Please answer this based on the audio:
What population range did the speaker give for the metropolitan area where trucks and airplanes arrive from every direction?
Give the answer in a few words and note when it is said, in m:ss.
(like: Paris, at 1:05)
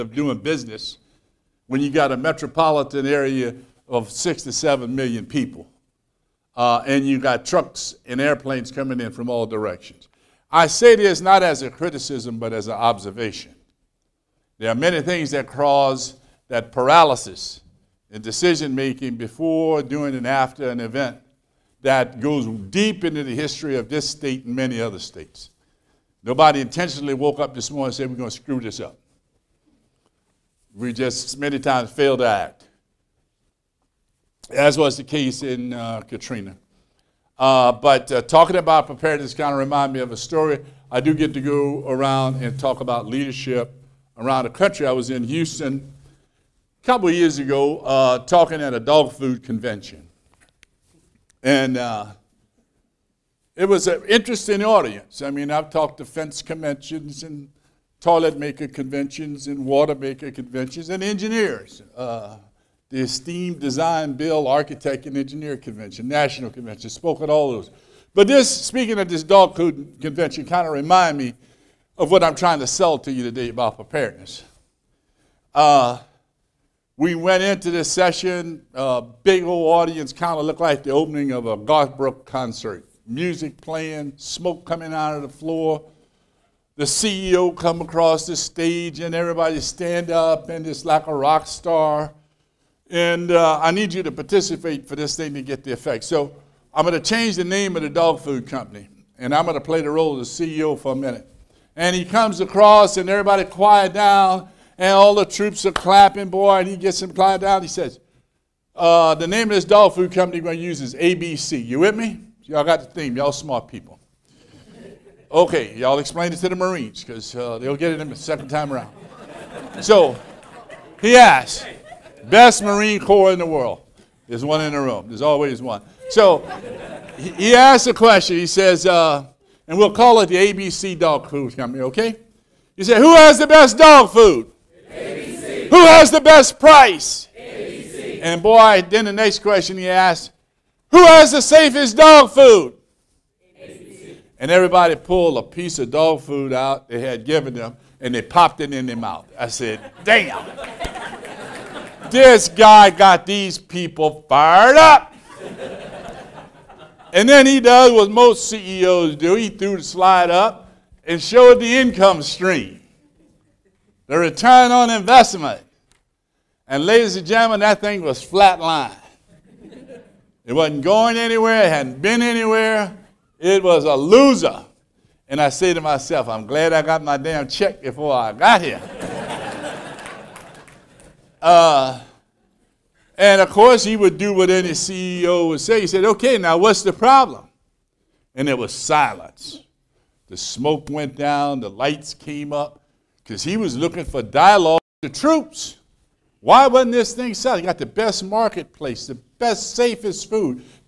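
6 to 7 million, at 0:04.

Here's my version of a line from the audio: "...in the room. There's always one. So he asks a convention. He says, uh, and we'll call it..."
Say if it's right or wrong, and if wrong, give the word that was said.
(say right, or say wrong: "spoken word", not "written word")
wrong: "question", not "convention".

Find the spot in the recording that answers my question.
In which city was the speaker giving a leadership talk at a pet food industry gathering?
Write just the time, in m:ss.
0:45.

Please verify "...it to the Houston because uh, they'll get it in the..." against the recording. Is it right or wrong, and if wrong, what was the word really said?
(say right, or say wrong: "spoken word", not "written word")
wrong: "Marines", not "Houston".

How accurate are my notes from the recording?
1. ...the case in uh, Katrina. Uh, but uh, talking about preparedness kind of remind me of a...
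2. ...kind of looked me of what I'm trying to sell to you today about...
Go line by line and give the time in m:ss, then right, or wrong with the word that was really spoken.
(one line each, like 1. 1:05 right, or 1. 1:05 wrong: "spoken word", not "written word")
1. 0:34 right
2. 1:10 wrong: "reminded", not "looked".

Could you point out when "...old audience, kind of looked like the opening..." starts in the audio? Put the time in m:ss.
1:19.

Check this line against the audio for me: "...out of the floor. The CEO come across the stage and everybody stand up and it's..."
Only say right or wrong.
right.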